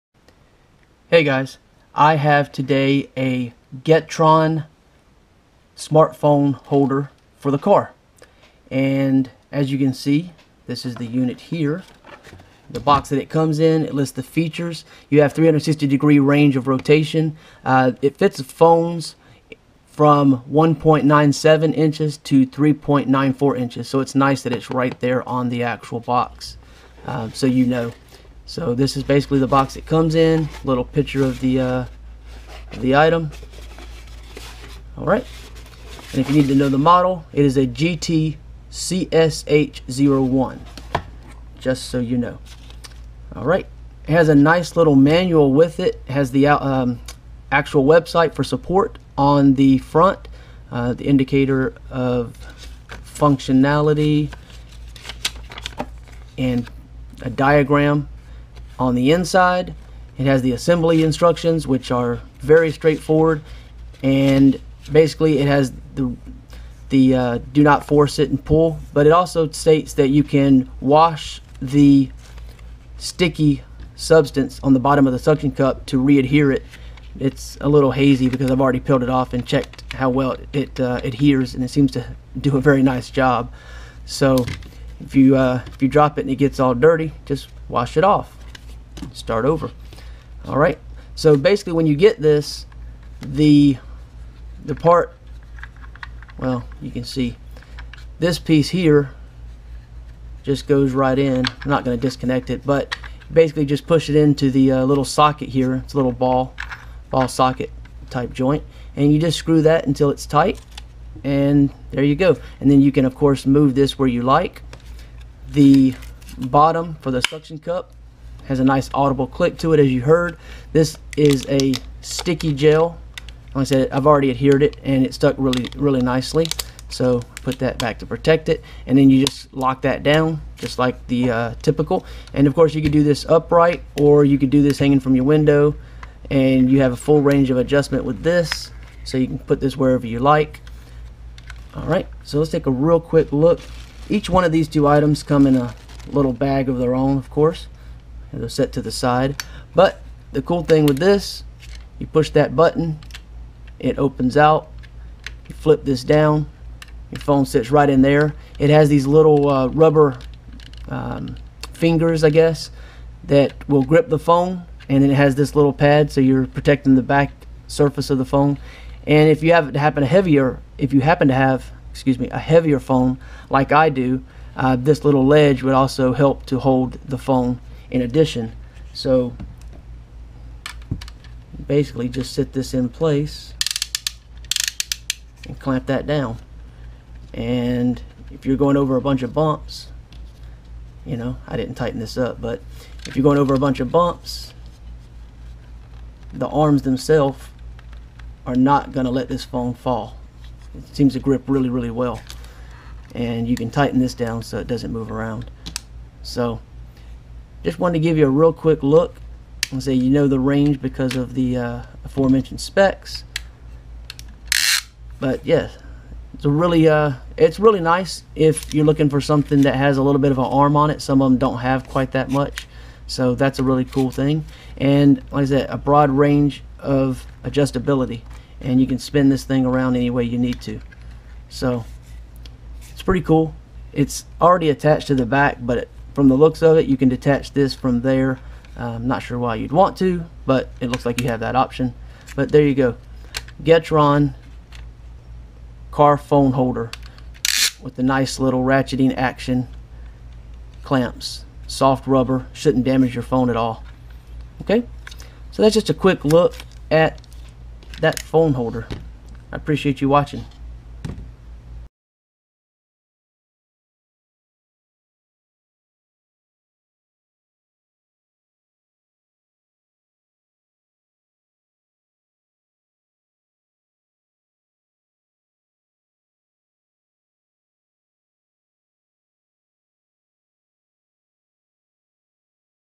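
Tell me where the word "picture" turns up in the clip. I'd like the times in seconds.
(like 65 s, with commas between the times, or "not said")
30 s.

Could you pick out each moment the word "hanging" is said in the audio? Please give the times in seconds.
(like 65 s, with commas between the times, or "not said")
134 s.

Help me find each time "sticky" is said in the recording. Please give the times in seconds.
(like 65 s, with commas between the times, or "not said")
72 s, 122 s.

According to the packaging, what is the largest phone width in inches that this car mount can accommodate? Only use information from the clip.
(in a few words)
3.94 inches.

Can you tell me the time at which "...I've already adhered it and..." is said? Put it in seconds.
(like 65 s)
123 s.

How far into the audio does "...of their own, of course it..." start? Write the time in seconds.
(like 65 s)
146 s.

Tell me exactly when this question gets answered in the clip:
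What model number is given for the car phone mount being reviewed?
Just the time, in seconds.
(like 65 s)
37 s.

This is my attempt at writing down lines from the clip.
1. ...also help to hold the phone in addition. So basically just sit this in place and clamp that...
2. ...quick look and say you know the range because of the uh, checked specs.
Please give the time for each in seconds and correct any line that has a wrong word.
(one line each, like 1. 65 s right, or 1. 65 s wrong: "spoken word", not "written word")
1. 175 s right
2. 208 s wrong: "aforementioned", not "checked".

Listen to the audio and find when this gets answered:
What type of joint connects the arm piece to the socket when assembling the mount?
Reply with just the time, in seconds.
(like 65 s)
107 s.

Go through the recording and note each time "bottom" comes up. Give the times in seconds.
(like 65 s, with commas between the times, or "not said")
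74 s, 116 s.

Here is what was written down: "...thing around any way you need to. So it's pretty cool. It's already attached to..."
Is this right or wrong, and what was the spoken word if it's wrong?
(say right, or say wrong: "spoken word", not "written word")
right.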